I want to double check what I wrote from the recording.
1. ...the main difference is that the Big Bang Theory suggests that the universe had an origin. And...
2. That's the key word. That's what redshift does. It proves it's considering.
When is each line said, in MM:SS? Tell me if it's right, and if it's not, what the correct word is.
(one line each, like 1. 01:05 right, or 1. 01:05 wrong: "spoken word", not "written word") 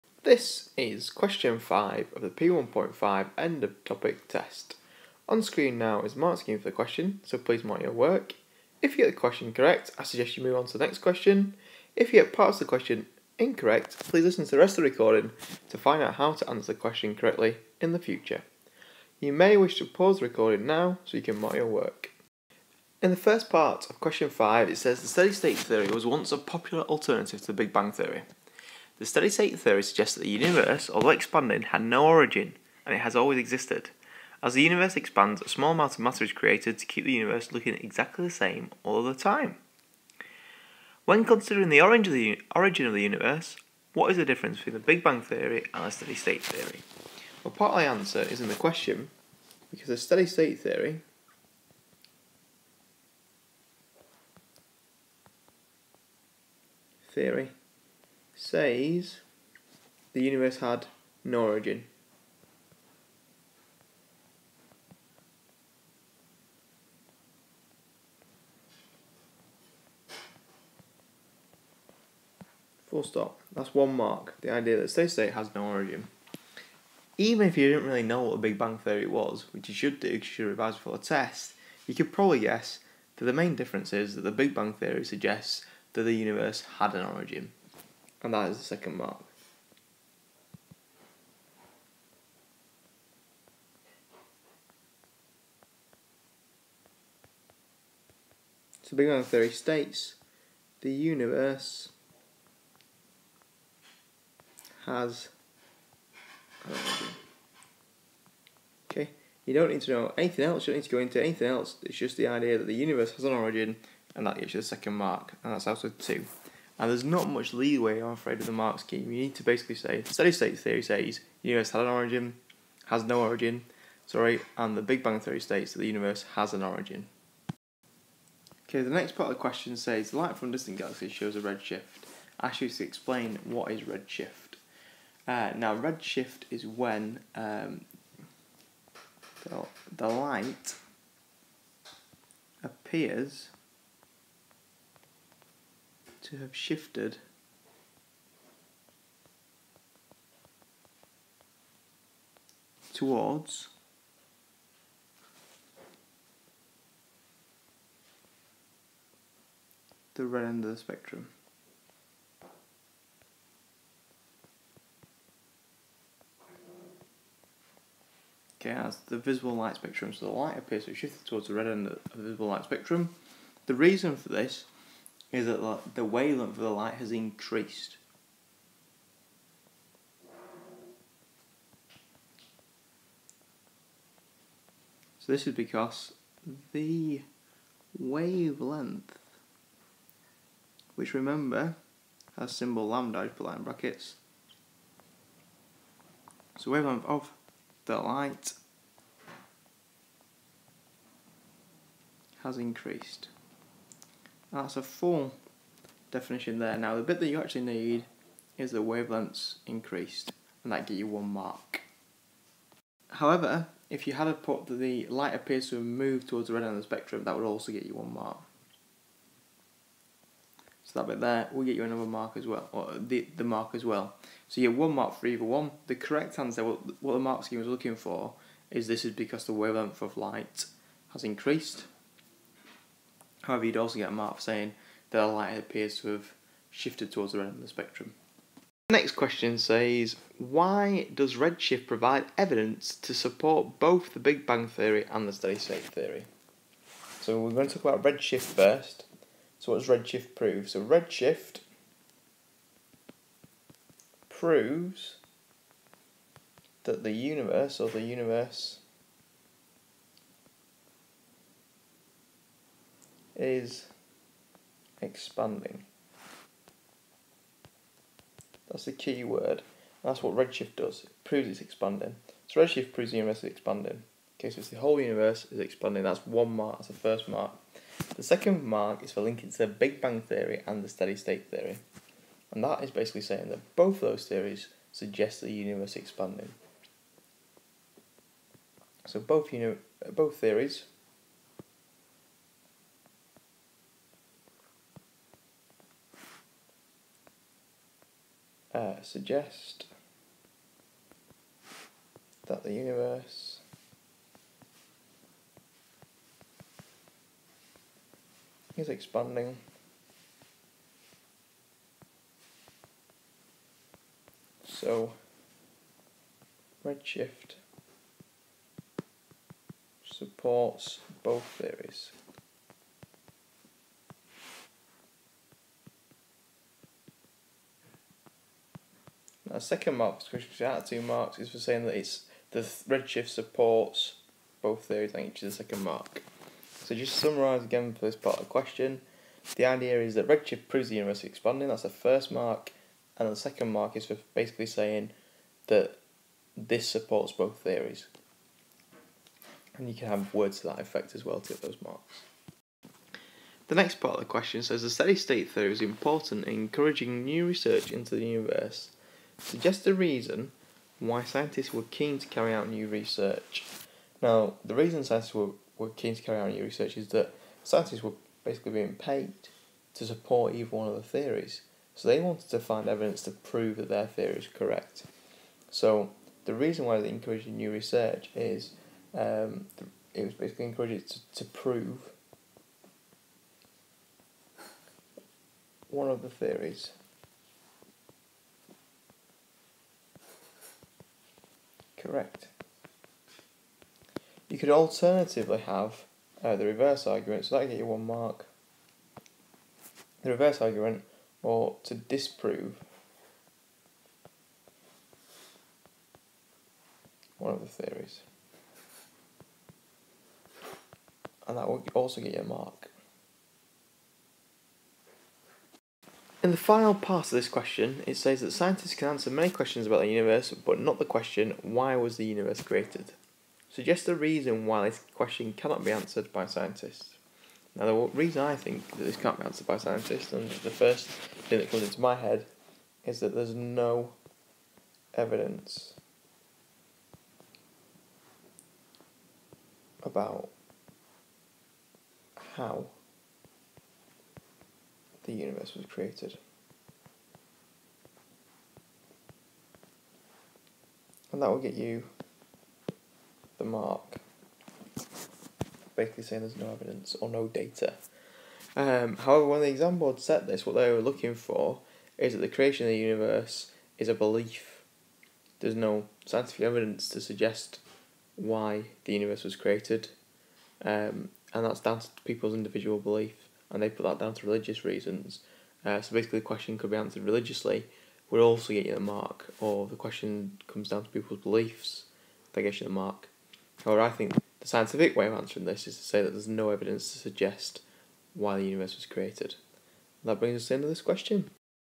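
1. 01:23 right
2. 04:28 wrong: "expanding", not "considering".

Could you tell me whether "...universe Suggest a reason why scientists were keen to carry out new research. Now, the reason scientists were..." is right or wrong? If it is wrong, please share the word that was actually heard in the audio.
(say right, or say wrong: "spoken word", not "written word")
right.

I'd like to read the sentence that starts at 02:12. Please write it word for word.
Ask you to explain what is redshift.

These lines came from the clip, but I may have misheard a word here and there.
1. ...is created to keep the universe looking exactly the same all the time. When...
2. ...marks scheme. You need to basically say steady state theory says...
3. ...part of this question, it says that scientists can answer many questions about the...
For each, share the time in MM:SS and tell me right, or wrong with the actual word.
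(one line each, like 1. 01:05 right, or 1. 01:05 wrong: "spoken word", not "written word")
1. 00:36 right
2. 01:58 right
3. 06:56 right.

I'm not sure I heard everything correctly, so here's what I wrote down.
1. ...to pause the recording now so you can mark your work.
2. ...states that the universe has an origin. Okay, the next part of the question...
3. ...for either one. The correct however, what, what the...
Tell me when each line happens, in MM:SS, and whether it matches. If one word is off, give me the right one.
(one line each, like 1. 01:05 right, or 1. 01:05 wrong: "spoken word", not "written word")
1. 00:19 right
2. 02:05 right
3. 03:45 wrong: "answer", not "however".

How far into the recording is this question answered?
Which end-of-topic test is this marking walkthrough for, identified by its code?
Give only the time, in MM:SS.
00:02.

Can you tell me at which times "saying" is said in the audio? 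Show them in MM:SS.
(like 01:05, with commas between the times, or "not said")
03:54, 04:43, 05:31, 05:44, 07:36.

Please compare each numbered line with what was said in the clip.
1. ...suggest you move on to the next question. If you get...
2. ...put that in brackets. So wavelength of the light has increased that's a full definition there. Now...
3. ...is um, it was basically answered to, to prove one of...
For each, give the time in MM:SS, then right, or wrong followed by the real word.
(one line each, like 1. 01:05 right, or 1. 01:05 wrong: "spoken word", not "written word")
1. 00:10 right
2. 03:13 right
3. 06:18 wrong: "encouraged", not "answered".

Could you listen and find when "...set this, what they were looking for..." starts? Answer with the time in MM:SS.
07:40.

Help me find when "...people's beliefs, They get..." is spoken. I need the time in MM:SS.
08:01.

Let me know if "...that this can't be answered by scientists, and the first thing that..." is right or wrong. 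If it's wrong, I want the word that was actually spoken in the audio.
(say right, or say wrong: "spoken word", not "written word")
right.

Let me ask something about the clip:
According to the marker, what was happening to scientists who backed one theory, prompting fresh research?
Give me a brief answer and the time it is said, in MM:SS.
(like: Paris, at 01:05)
paid, at 06:08.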